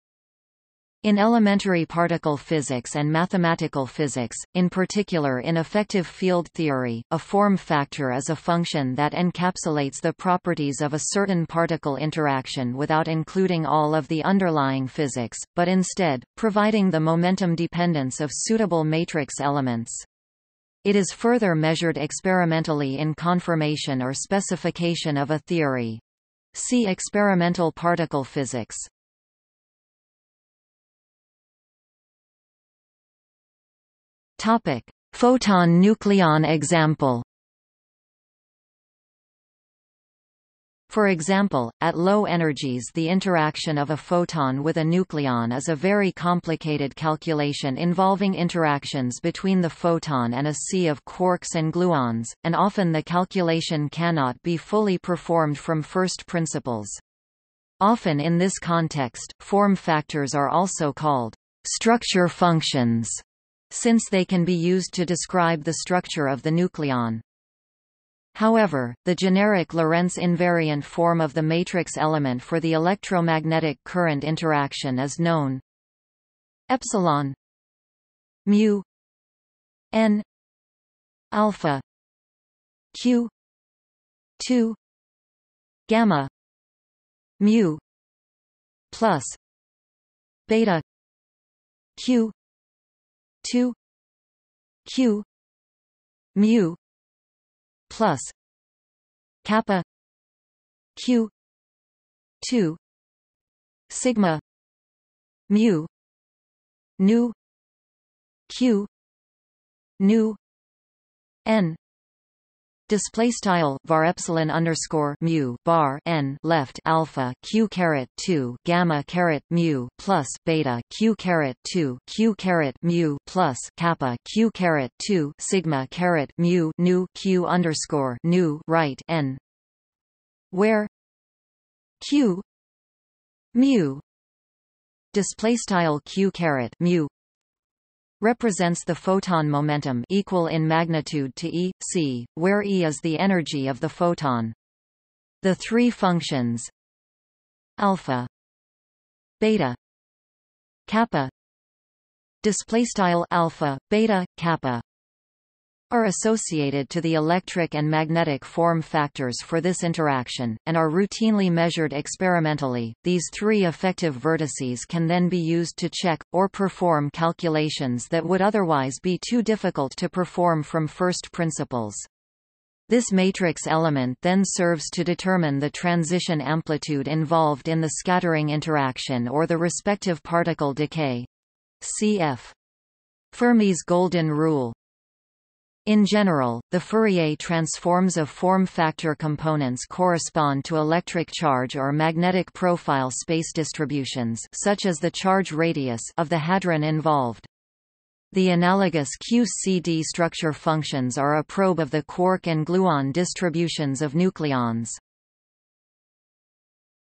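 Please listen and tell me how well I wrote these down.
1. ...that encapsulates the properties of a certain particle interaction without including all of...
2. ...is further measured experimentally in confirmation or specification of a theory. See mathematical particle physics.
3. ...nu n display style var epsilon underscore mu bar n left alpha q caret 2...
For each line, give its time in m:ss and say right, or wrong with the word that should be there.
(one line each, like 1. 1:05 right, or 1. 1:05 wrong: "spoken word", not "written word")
1. 0:08 right
2. 0:20 wrong: "experimental", not "mathematical"
3. 1:49 right.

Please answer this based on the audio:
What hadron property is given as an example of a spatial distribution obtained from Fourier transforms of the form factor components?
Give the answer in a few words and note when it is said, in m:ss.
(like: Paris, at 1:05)
charge radius, at 3:15.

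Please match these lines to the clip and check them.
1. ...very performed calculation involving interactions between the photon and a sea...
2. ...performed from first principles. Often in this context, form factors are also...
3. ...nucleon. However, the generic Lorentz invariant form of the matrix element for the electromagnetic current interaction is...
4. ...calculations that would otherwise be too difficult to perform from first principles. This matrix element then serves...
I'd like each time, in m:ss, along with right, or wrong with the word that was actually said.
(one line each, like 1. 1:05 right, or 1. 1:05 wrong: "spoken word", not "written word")
1. 0:45 wrong: "complicated", not "performed"
2. 0:54 right
3. 1:06 right
4. 2:47 right.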